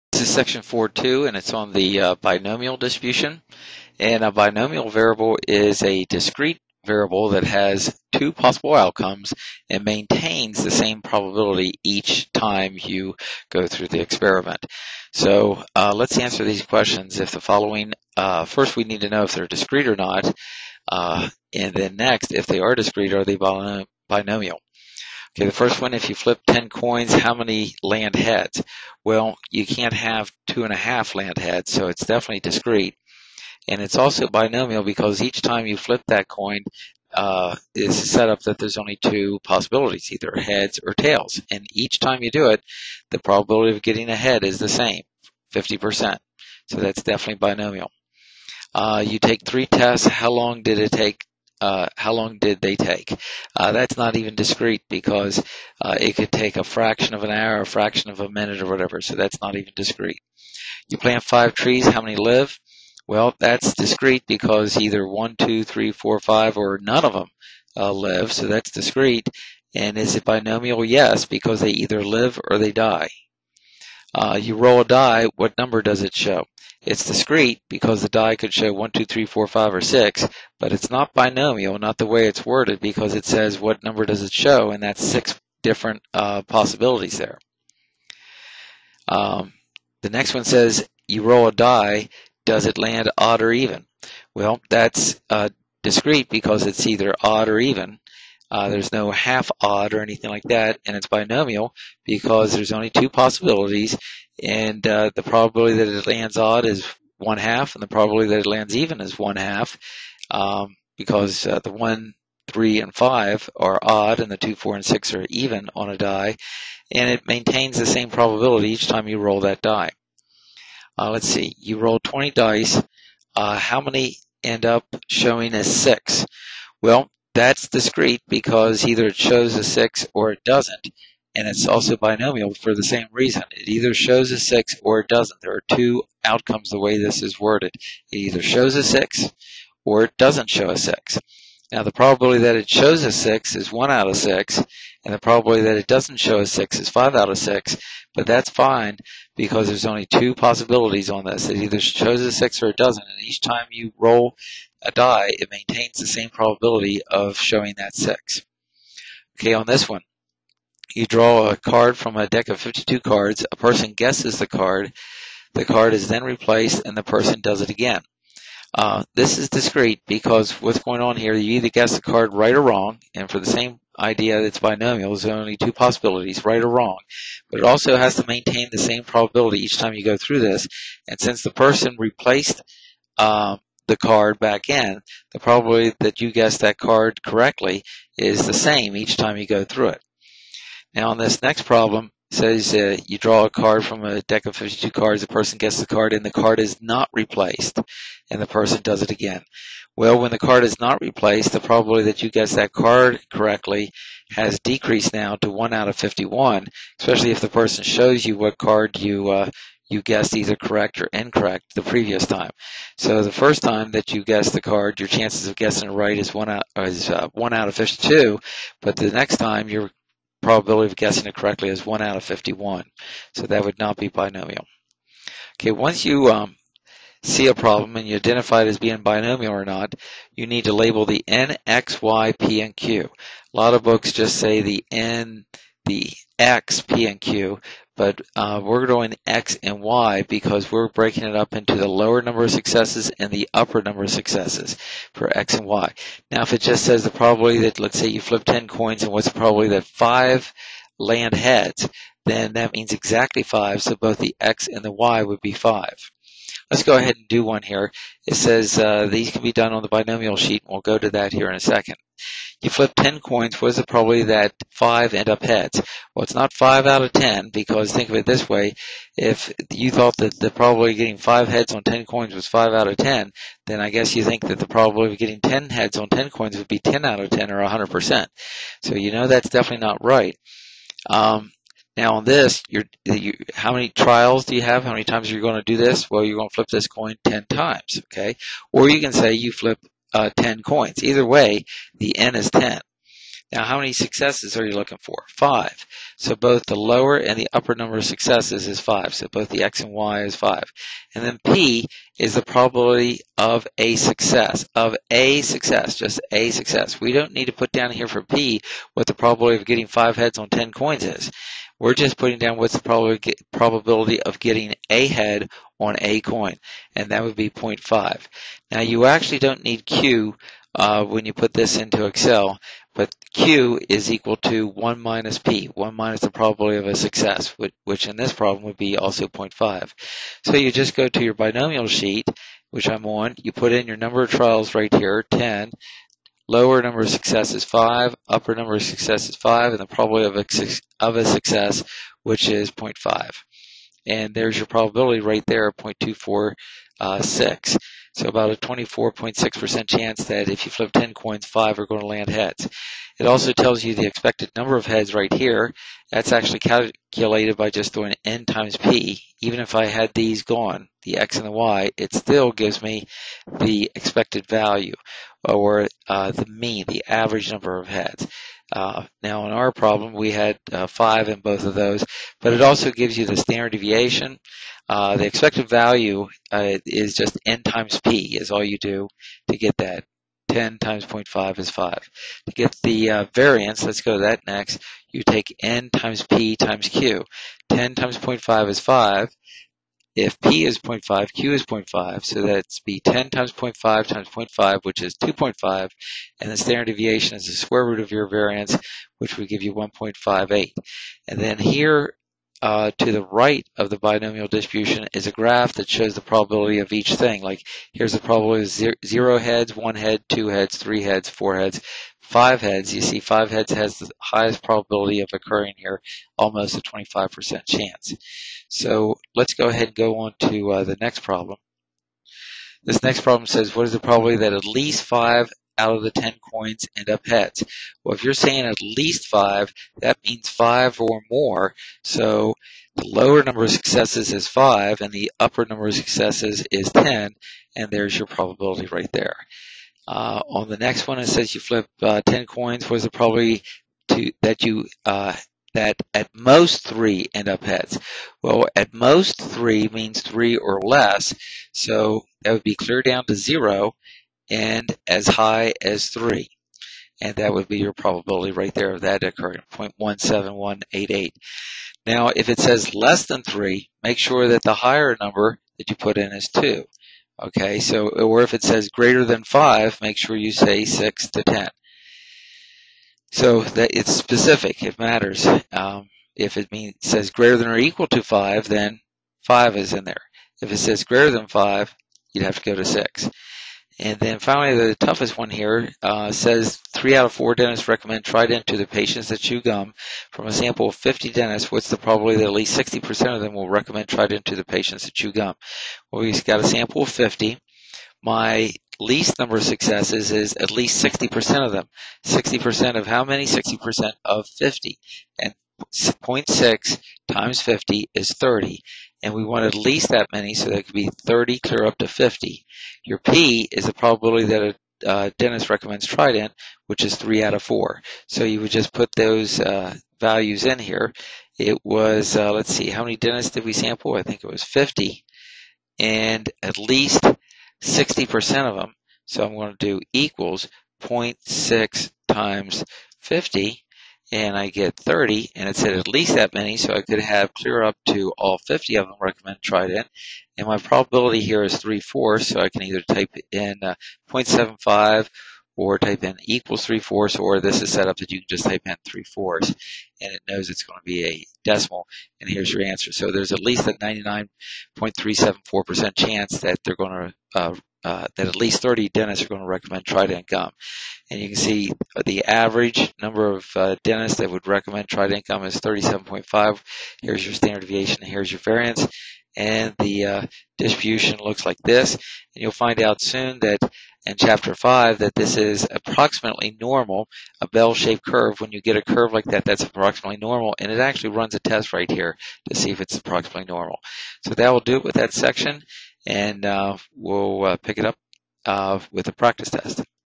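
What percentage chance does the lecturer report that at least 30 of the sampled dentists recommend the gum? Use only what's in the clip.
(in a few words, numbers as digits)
99.374%.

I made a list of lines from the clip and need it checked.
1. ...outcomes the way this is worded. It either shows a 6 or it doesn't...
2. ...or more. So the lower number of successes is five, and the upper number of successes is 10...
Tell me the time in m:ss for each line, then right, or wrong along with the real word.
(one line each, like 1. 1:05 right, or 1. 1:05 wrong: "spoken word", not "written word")
1. 2:16 right
2. 7:11 right.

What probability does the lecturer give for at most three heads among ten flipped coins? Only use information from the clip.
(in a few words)
0.17188.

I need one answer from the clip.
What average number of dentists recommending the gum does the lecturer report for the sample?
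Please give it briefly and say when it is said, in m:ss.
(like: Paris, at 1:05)
37.5, at 9:25.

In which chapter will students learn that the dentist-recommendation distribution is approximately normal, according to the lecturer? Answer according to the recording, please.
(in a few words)
Chapter 5.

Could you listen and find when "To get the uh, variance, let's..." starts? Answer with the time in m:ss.
6:22.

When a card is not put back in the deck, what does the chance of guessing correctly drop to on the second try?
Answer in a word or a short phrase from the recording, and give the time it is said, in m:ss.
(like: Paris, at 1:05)
1 out of 51, at 3:25.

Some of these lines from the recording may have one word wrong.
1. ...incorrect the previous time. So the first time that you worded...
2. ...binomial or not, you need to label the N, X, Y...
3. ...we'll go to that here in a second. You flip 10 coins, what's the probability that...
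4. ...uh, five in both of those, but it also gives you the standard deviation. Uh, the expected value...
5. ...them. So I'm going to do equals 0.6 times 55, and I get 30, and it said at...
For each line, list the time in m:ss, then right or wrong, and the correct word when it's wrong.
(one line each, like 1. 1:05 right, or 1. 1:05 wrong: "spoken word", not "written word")
1. 3:31 wrong: "guessed", not "worded"
2. 3:49 right
3. 4:20 right
4. 6:10 right
5. 8:48 wrong: "50", not "55".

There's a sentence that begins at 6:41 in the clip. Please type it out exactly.
And then here uh, to the right of the binomial distribution is a graph that shows the probability of each thing.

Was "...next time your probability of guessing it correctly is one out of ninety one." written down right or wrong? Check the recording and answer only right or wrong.
wrong.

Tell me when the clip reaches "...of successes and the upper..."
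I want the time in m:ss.
4:02.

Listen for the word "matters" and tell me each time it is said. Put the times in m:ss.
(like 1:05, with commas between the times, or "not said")
7:54.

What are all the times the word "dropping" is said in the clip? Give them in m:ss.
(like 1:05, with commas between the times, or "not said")
not said.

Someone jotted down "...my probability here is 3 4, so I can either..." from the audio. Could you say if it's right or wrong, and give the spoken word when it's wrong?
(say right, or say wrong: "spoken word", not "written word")
right.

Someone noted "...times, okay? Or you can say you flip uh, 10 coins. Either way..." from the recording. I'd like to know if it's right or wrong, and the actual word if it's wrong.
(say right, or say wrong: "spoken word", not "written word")
right.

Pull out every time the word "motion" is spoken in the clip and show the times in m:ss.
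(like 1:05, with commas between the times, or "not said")
not said.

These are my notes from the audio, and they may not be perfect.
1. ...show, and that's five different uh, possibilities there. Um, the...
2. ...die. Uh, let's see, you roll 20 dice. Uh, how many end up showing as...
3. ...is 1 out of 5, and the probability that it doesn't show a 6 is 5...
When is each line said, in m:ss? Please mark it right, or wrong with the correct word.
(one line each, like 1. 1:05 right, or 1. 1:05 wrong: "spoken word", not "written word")
1. 1:24 wrong: "six", not "five"
2. 1:59 right
3. 2:23 wrong: "6", not "5".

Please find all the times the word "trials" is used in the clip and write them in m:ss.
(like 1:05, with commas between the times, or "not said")
4:43, 5:34.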